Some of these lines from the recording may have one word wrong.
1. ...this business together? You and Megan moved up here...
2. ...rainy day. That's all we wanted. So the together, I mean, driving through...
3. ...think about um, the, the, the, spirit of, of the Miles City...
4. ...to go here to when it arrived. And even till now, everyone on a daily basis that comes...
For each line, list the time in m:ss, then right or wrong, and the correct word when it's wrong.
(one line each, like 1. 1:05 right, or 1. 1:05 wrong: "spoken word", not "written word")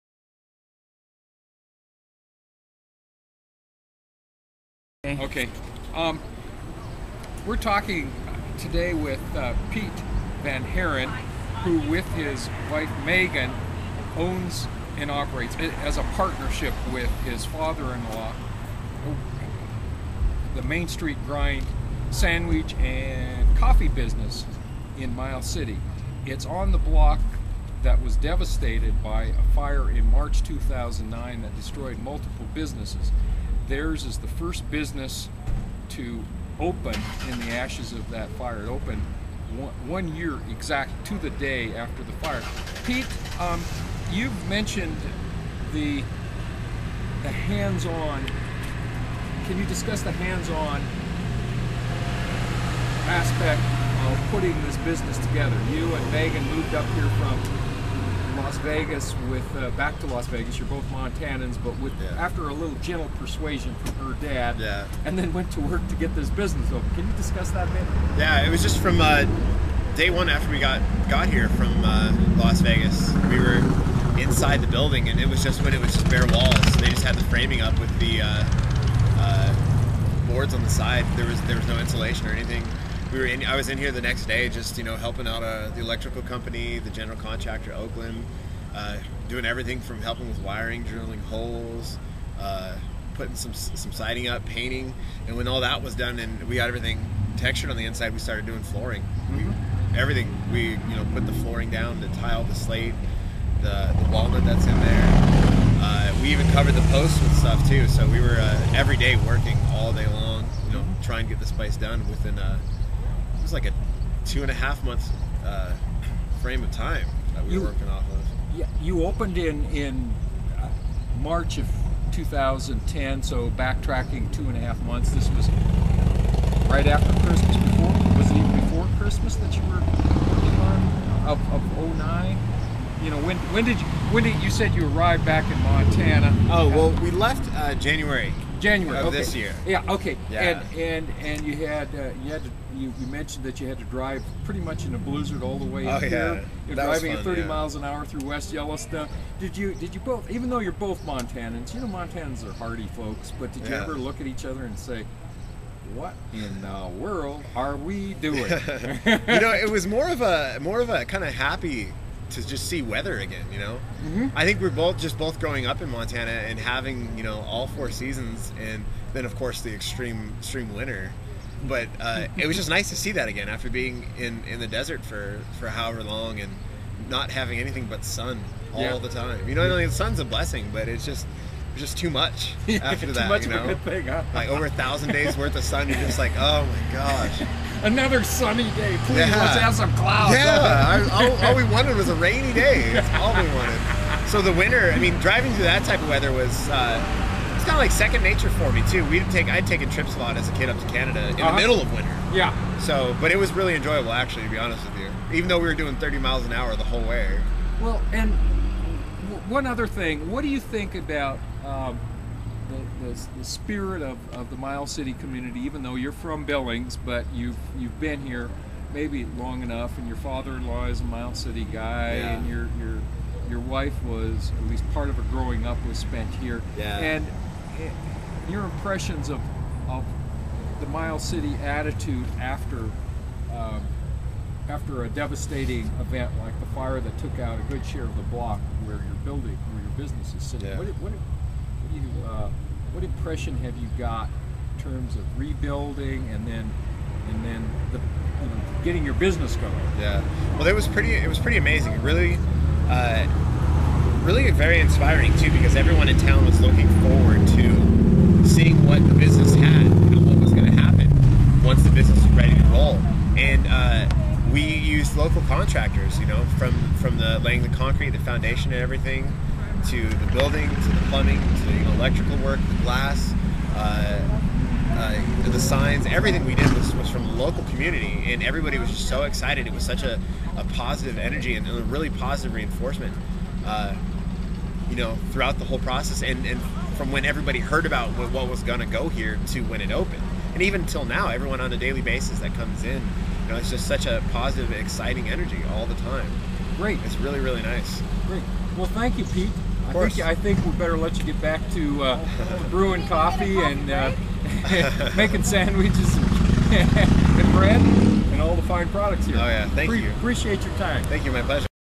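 1. 0:54 right
2. 3:12 wrong: "winter", not "together"
3. 3:30 right
4. 4:48 wrong: "opened", not "arrived".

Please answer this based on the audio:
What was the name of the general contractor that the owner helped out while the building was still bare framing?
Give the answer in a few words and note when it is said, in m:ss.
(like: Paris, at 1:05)
Oakland, at 1:27.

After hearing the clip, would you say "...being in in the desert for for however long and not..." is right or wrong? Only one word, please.
right.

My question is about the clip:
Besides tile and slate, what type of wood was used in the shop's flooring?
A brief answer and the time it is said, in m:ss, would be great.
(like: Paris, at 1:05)
Walnut, at 1:44.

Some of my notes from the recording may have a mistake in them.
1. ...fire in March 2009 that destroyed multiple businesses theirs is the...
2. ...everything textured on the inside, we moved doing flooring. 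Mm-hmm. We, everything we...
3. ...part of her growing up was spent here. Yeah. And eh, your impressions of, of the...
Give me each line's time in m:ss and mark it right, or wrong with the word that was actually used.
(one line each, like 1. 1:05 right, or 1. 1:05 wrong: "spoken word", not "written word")
1. 0:29 right
2. 1:36 wrong: "started", not "moved"
3. 3:44 right.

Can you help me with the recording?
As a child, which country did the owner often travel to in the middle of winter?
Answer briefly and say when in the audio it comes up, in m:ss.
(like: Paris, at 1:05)
Canada, at 3:20.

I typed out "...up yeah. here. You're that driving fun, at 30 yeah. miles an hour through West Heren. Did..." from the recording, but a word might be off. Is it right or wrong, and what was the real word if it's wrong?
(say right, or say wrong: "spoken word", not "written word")
wrong: "Yellowstone", not "Heren".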